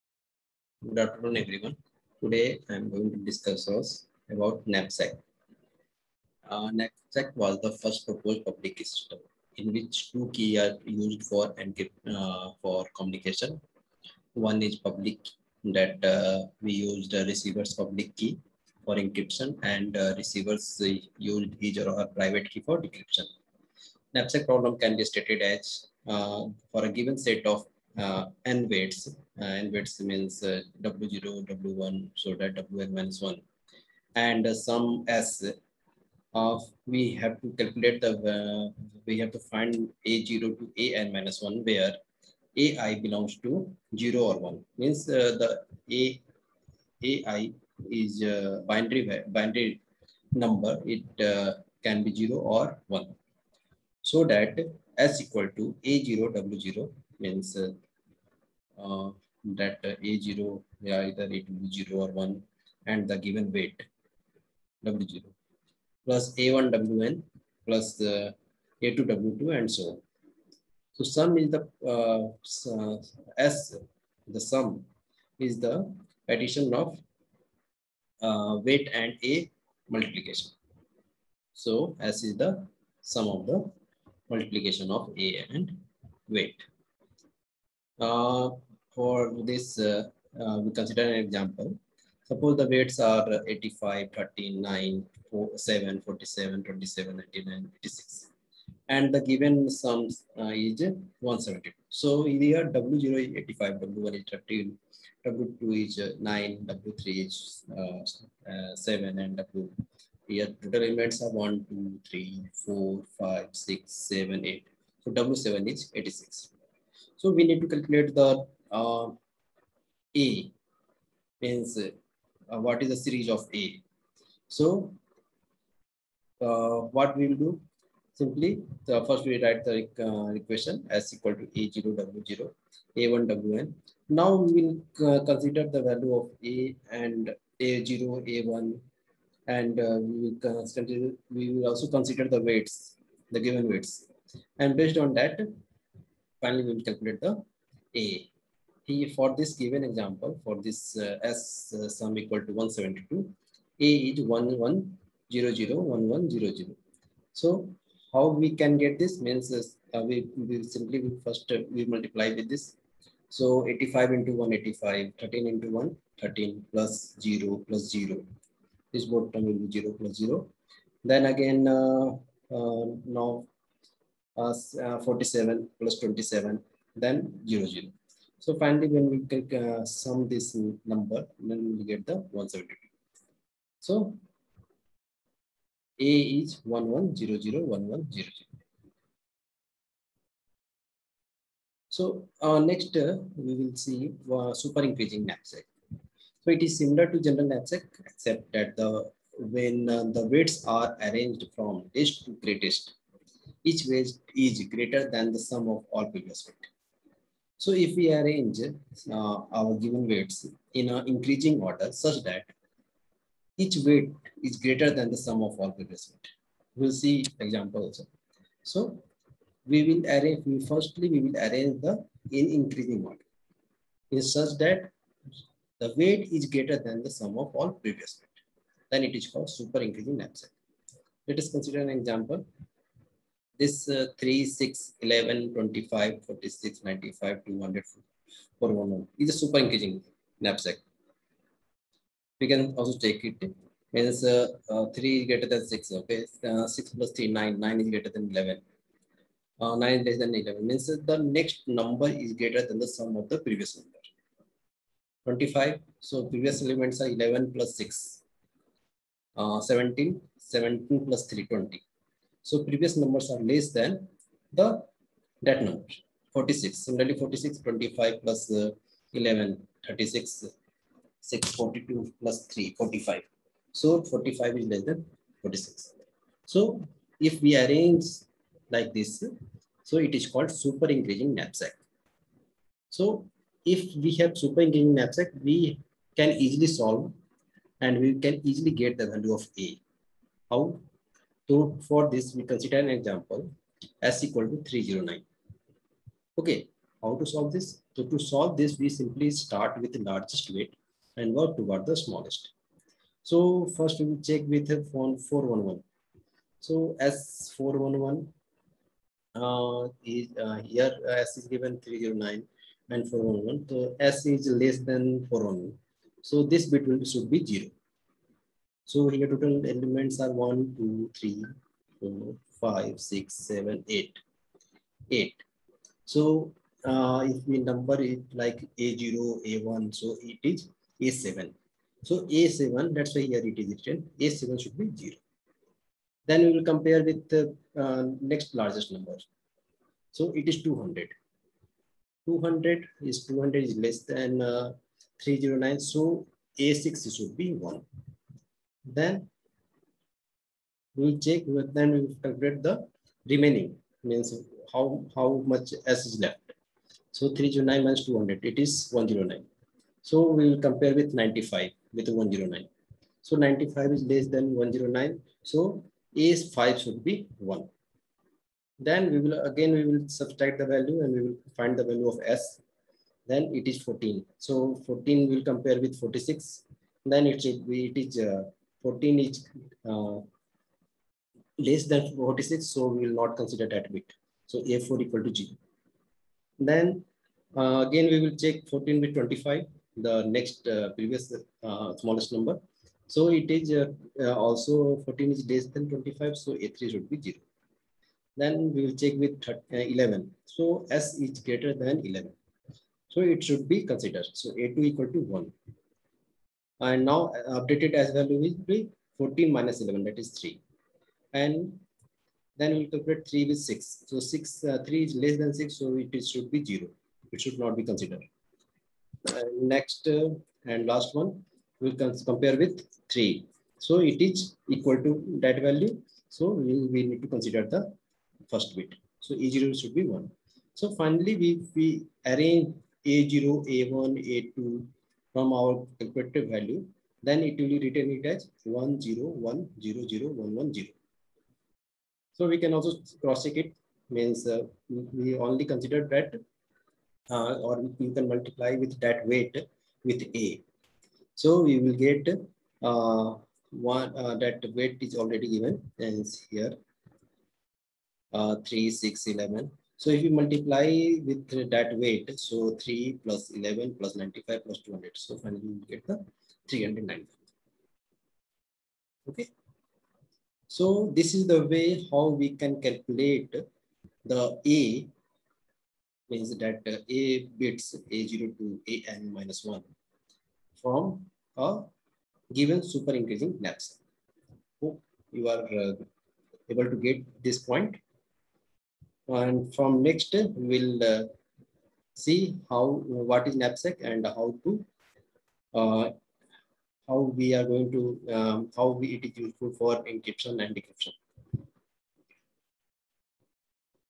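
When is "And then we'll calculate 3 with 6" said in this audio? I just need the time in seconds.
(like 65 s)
411 s.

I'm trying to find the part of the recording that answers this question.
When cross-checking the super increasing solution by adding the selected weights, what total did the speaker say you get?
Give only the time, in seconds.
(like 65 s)
465 s.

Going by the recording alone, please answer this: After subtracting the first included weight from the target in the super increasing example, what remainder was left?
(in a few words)
109.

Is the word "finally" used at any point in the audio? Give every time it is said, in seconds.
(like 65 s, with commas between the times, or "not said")
146 s, 178 s, 430 s, 465 s.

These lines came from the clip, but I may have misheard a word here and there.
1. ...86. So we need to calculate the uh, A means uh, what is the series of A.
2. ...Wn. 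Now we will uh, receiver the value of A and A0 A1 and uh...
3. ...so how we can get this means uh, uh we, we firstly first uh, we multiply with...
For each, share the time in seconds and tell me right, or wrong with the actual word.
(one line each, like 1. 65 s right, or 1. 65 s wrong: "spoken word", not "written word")
1. 115 s right
2. 133 s wrong: "consider", not "receiver"
3. 157 s wrong: "simply", not "firstly".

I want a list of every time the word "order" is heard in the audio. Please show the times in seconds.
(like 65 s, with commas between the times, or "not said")
211 s, 223 s.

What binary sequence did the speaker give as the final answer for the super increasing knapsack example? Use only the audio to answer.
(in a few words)
10100110.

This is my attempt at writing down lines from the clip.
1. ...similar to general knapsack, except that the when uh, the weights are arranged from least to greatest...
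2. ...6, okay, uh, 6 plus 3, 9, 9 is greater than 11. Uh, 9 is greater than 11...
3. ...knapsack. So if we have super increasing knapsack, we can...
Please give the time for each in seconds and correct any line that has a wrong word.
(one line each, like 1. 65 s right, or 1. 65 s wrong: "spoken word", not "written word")
1. 196 s right
2. 245 s right
3. 281 s right.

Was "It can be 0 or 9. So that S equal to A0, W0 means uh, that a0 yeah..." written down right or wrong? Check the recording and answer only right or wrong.
wrong.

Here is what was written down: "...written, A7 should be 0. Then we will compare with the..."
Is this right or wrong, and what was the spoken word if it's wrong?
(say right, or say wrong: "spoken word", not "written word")
right.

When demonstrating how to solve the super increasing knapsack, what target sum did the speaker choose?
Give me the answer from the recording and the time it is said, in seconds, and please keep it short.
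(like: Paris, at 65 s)
309, at 294 s.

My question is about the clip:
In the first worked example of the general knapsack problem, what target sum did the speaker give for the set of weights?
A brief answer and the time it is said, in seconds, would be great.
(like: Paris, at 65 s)
172, at 99 s.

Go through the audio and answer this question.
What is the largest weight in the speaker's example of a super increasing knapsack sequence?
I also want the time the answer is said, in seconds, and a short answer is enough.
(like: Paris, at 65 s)
411, at 237 s.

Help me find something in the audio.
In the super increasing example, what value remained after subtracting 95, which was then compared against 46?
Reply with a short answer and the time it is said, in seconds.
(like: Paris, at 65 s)
14, at 373 s.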